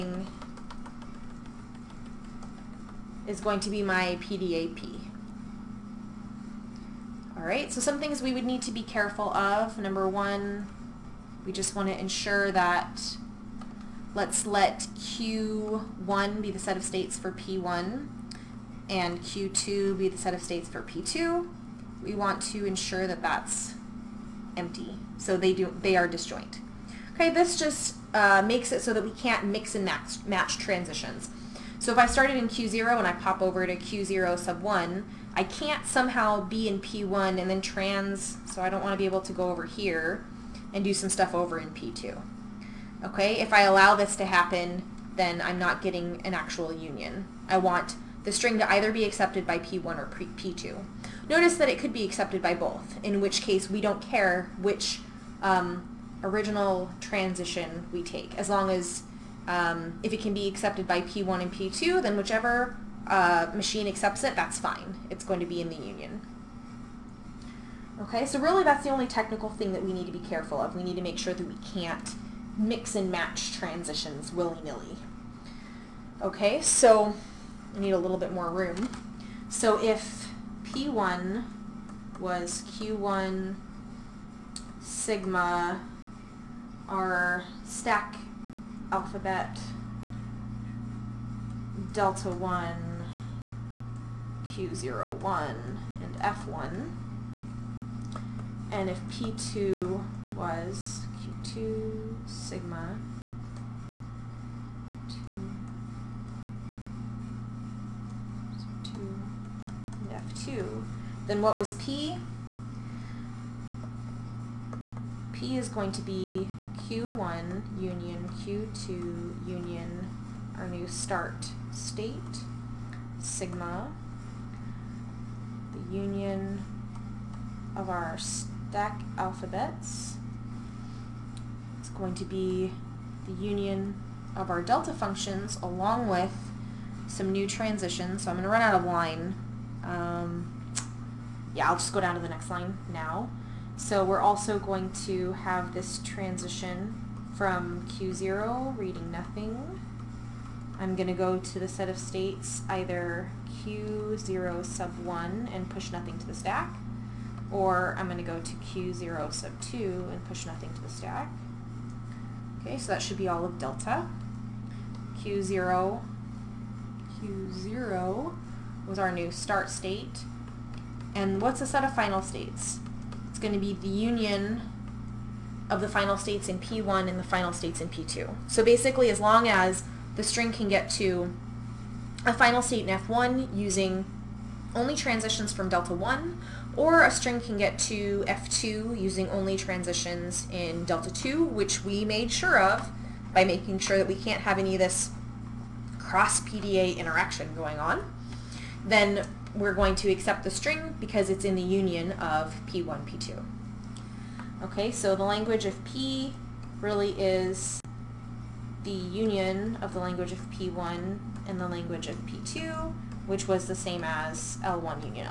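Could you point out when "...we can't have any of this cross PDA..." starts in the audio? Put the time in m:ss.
3:14.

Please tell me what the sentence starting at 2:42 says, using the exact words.
Okay, so that should be all of delta.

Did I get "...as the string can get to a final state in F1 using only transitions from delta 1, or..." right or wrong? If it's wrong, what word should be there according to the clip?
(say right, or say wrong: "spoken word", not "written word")
right.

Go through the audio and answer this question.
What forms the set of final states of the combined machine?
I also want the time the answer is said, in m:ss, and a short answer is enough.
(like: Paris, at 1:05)
union of F1 and F2, at 2:53.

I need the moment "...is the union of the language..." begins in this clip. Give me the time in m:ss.
3:27.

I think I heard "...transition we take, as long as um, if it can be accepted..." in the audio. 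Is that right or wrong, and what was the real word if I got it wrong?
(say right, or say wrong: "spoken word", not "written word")
right.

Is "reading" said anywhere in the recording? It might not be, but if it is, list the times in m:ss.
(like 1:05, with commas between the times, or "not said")
2:28.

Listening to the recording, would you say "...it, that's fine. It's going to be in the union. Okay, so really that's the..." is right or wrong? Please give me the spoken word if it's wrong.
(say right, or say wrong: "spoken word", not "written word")
right.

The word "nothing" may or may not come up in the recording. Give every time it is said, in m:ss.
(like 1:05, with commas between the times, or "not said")
2:29, 2:35, 2:40.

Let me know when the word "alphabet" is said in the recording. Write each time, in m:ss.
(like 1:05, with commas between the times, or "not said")
1:28, 2:09.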